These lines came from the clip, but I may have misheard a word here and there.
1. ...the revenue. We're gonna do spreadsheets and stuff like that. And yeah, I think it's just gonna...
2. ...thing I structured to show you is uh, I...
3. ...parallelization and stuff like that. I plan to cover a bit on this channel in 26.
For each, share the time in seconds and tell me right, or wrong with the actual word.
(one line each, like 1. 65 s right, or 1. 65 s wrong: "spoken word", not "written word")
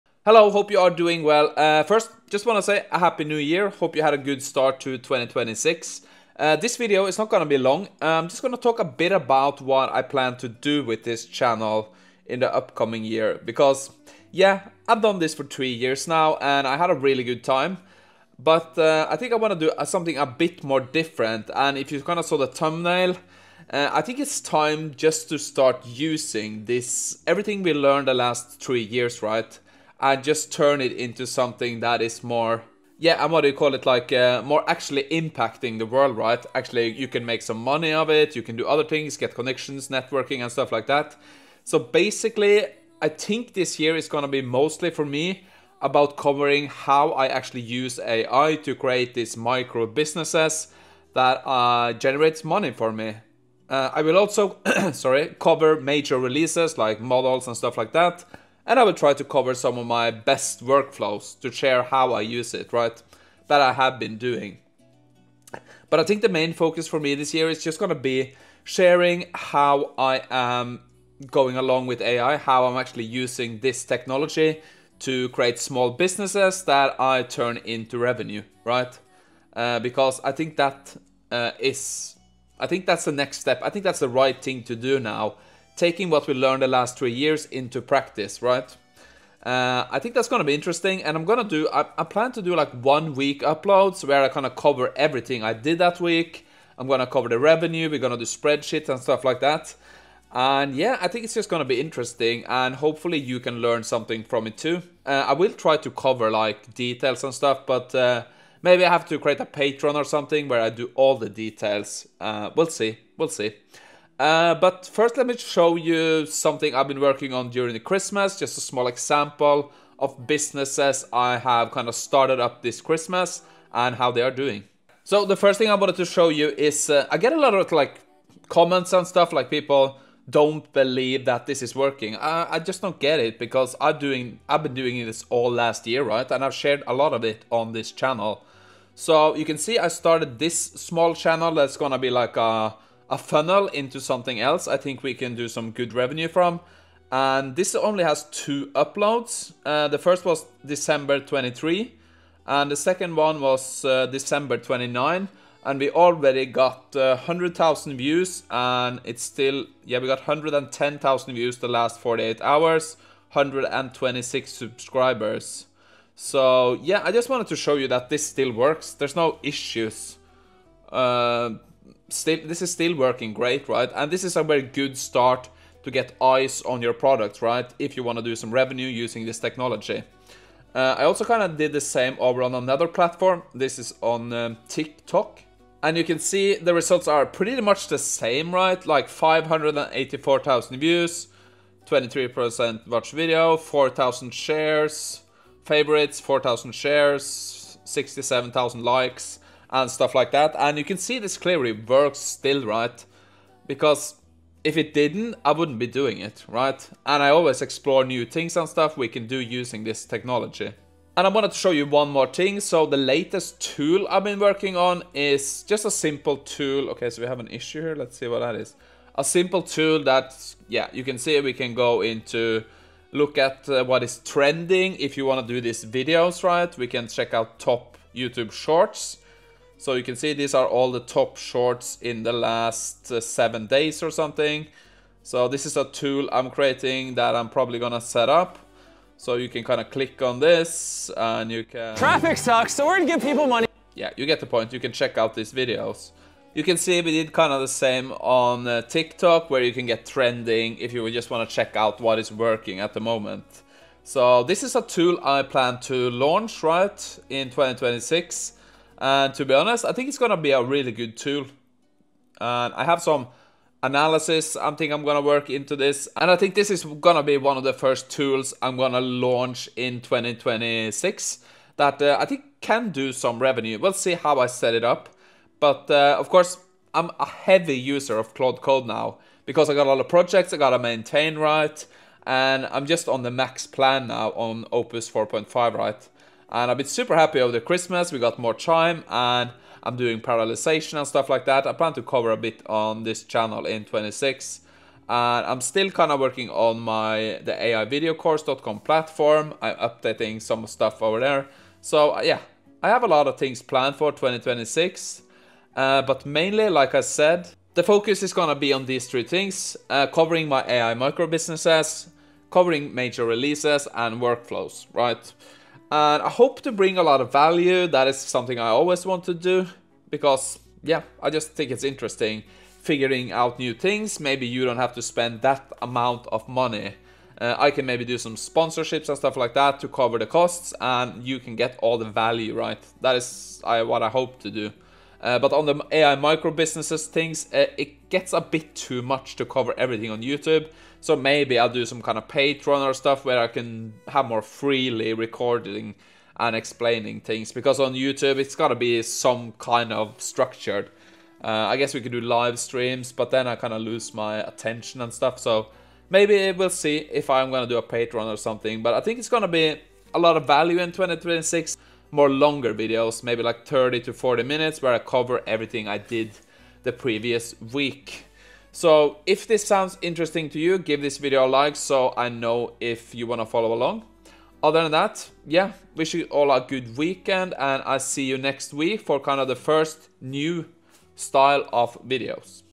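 1. 97 s right
2. 125 s wrong: "wanted", not "structured"
3. 290 s right.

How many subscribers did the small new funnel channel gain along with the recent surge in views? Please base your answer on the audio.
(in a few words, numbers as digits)
126.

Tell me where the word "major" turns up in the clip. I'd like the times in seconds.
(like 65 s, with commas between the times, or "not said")
55 s, 312 s.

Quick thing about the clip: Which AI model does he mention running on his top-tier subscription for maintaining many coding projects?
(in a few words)
Opus 4.5.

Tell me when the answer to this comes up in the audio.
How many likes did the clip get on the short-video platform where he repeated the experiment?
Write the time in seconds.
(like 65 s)
197 s.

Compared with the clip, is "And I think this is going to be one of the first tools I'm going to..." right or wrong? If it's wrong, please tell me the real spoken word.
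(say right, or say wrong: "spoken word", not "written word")
right.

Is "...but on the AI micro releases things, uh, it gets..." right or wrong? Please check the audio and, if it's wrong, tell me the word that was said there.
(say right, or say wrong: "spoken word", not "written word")
wrong: "businesses", not "releases".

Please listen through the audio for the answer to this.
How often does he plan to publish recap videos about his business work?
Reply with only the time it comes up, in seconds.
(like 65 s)
92 s.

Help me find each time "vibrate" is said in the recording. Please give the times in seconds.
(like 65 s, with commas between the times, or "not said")
not said.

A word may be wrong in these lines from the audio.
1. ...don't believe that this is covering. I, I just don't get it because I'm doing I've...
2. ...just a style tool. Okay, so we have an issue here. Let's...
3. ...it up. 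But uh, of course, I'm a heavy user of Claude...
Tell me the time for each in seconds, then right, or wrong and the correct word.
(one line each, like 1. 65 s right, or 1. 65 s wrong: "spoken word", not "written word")
1. 130 s wrong: "working", not "covering"
2. 215 s wrong: "simple", not "style"
3. 274 s right.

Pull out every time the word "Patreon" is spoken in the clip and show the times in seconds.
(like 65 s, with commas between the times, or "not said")
109 s, 342 s, 357 s.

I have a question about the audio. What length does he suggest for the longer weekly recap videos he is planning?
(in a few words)
30 to 40 minutes.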